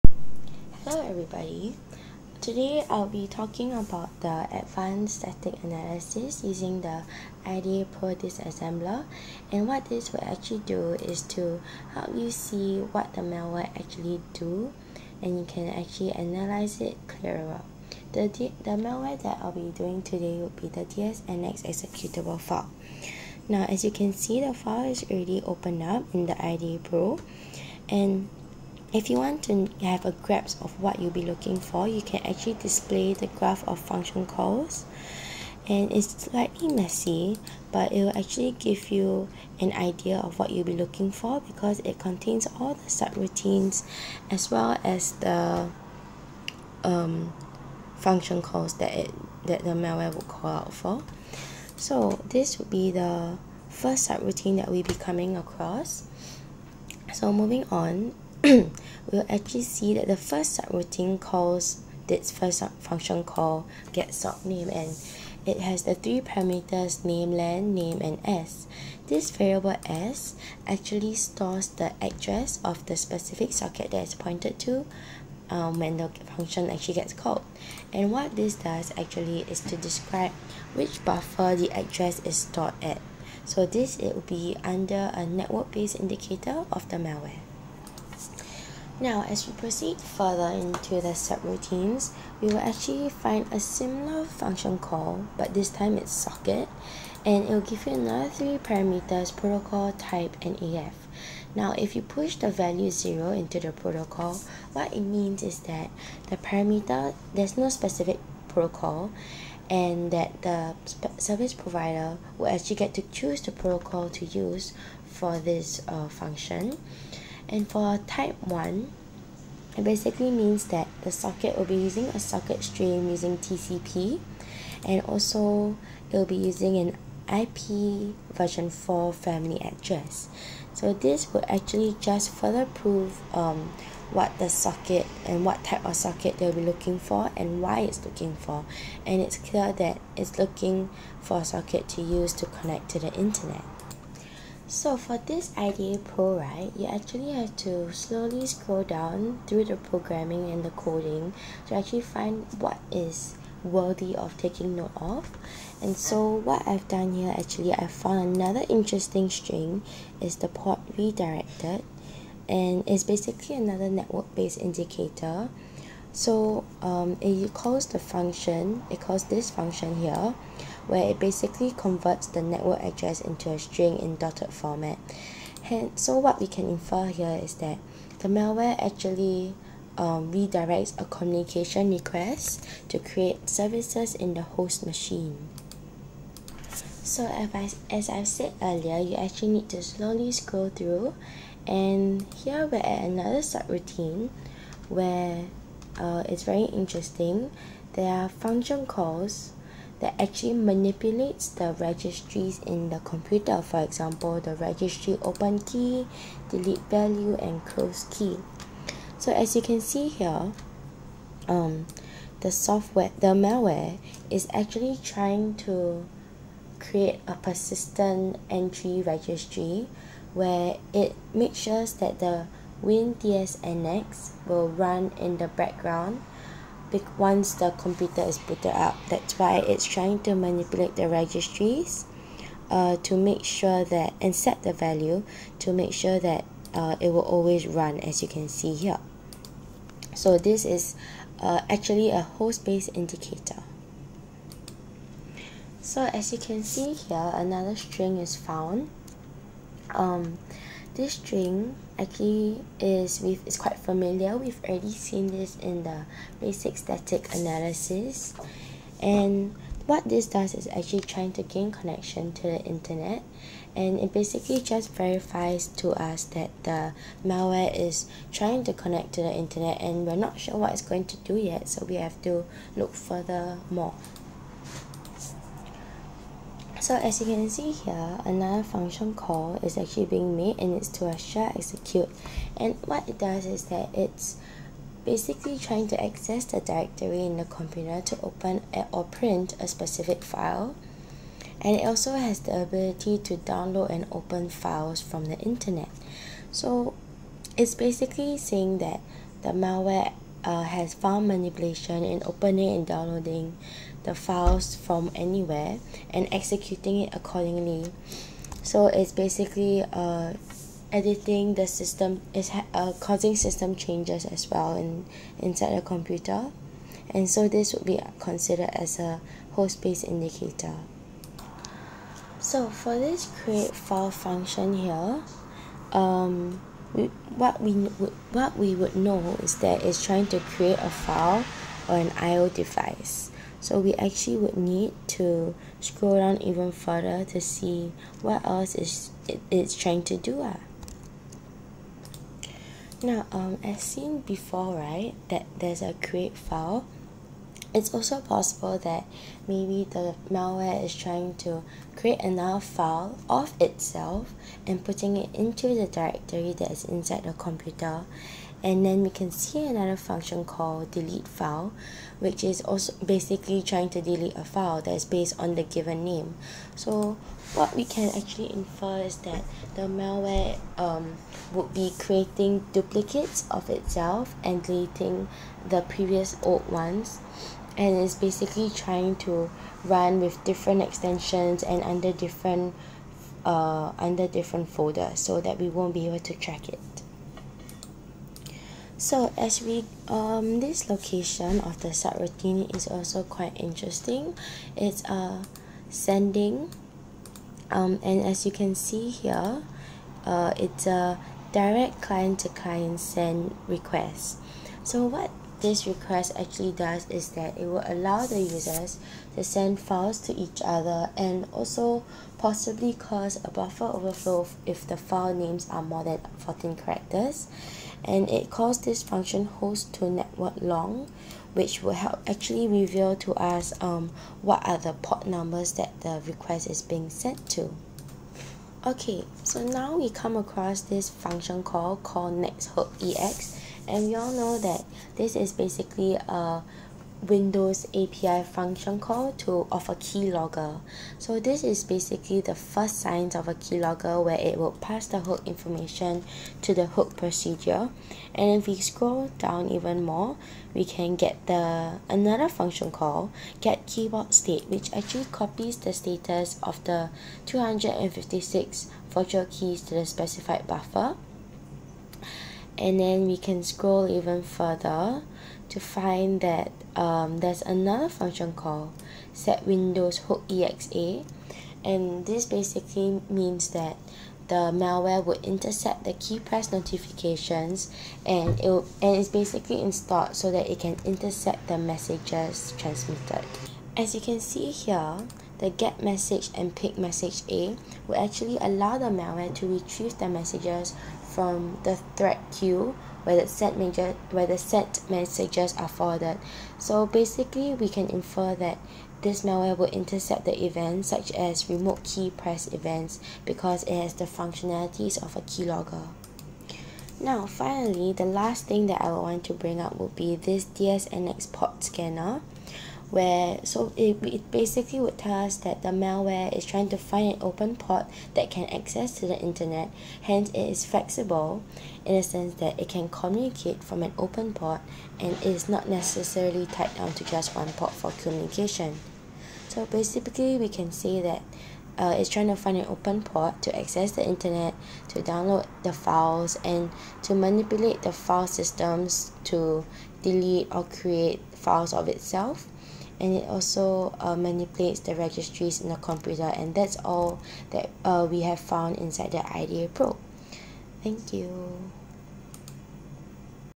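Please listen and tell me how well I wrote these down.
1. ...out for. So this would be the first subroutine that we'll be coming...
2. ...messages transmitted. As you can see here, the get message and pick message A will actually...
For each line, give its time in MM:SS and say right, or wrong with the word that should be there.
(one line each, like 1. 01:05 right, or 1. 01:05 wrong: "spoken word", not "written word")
1. 00:50 right
2. 08:01 right.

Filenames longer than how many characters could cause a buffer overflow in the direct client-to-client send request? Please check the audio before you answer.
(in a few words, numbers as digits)
14.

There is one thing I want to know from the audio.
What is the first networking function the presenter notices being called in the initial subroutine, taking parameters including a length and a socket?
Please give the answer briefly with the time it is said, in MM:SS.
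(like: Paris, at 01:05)
getsockname, at 01:03.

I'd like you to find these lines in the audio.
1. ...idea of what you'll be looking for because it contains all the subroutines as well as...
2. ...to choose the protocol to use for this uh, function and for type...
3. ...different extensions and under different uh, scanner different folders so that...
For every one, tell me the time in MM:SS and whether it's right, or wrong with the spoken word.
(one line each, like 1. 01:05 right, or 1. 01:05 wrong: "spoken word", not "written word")
1. 00:39 right
2. 01:52 right
3. 06:20 wrong: "under", not "scanner".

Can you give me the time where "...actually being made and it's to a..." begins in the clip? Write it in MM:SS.
04:39.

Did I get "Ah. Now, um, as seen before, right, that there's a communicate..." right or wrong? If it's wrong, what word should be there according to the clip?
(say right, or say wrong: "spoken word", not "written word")
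wrong: "create", not "communicate".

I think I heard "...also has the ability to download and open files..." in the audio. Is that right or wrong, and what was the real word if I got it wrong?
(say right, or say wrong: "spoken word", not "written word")
right.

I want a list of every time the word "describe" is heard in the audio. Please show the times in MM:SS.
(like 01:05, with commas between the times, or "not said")
01:19.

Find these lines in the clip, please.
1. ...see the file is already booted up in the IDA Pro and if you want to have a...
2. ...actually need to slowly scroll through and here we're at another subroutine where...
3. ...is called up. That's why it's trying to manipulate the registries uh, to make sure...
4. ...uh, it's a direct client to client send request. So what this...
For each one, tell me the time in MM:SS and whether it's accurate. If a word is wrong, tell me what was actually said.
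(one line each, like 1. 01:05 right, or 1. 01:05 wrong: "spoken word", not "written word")
1. 00:24 wrong: "opened", not "booted"
2. 03:09 right
3. 03:48 wrong: "booted", not "called"
4. 06:40 right.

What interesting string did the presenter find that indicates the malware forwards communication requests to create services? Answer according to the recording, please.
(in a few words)
port redirected.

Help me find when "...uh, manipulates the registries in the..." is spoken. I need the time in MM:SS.
09:04.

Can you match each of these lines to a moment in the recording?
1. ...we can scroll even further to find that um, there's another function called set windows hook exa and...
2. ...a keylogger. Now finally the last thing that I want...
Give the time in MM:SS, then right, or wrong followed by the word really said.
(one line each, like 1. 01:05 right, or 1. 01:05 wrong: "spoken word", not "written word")
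1. 07:43 right
2. 08:25 right.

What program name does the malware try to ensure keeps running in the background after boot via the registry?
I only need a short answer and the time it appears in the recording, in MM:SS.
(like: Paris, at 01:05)
WinDSNX, at 03:42.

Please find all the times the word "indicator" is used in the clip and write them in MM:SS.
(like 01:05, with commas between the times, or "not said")
01:25, 02:44, 04:02, 05:20.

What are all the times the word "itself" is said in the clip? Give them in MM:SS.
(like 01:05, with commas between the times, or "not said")
05:53, 06:13, 09:02.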